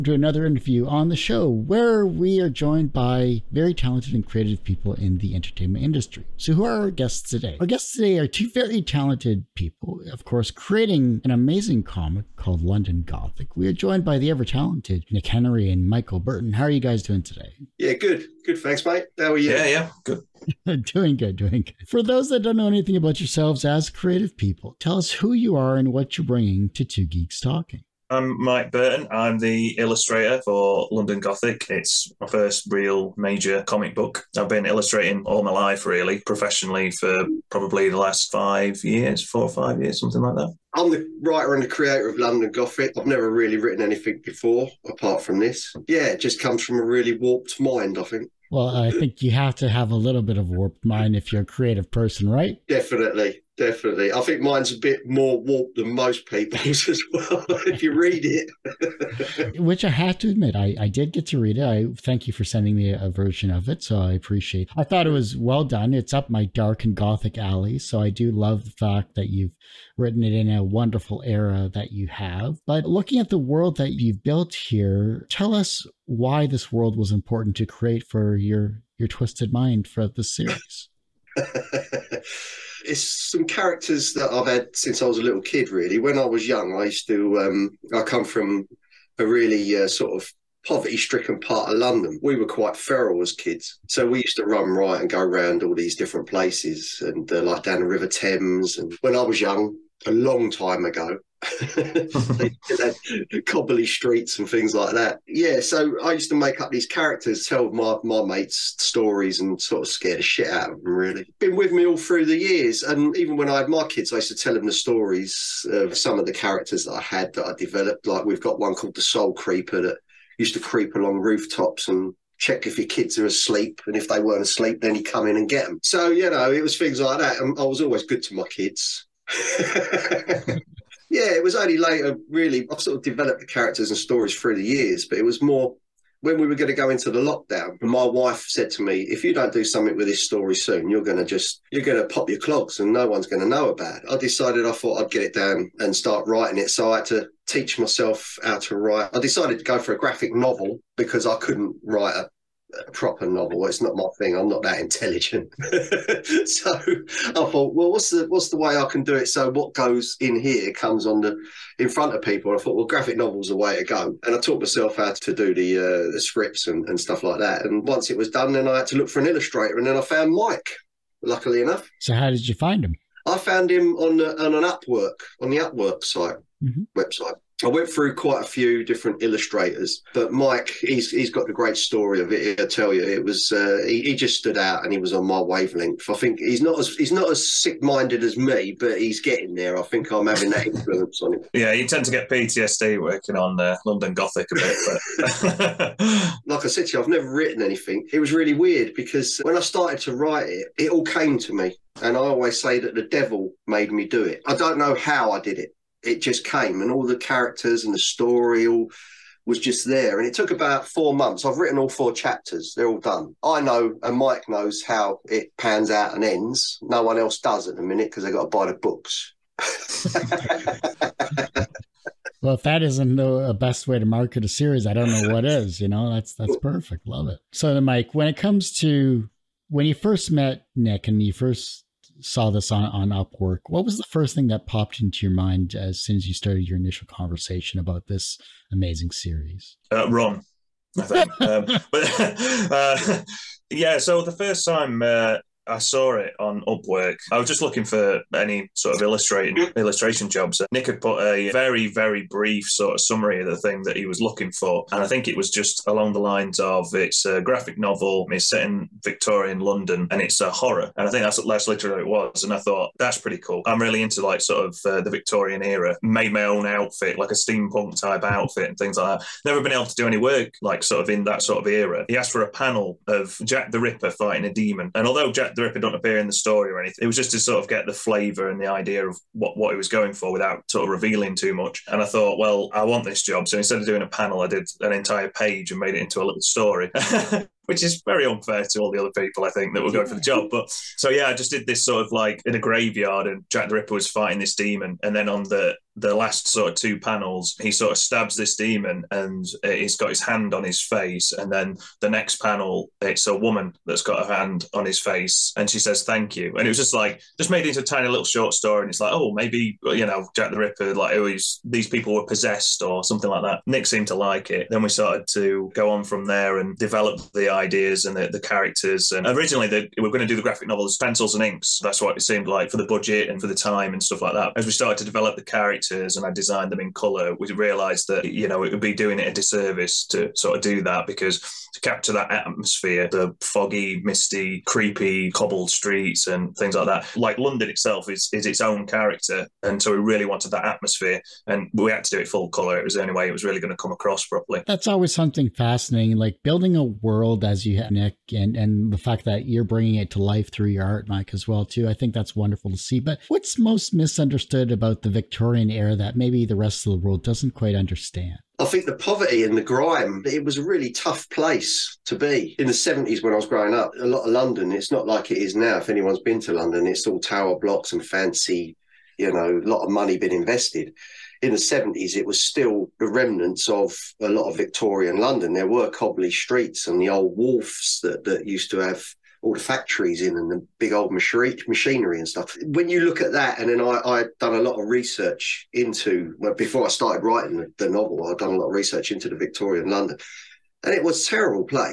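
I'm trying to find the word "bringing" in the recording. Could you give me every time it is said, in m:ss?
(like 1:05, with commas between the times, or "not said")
0:26, 5:49.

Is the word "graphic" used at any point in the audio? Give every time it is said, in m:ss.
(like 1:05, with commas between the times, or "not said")
2:29, 2:42, 4:17, 5:20.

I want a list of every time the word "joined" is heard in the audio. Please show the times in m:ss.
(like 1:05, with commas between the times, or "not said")
0:02, 0:13.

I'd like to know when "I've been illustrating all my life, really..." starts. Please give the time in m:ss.
0:34.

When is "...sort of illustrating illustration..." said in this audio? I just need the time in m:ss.
4:08.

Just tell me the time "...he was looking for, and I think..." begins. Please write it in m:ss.
4:13.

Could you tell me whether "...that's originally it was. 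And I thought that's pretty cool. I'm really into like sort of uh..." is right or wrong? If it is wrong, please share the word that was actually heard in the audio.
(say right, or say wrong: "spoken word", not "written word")
wrong: "literally", not "originally".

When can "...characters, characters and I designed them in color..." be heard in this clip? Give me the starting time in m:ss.
5:25.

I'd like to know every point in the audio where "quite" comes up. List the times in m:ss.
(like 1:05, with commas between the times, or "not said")
1:32, 2:58, 5:57.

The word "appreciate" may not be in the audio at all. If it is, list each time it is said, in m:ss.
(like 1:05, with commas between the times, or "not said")
1:04.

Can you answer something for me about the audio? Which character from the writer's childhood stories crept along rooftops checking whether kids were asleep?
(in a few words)
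The Soul Creeper.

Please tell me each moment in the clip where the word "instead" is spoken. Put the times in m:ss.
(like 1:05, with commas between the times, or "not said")
4:43.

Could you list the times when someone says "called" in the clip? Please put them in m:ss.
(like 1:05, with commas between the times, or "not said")
0:12, 1:58.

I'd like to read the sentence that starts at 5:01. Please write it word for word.
And then the next panel, it's a woman that's got her hand on his face and she says, Thank you.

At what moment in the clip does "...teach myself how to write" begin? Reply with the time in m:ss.
2:27.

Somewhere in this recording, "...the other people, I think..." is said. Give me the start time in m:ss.
4:48.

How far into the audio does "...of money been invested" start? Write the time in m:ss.
6:09.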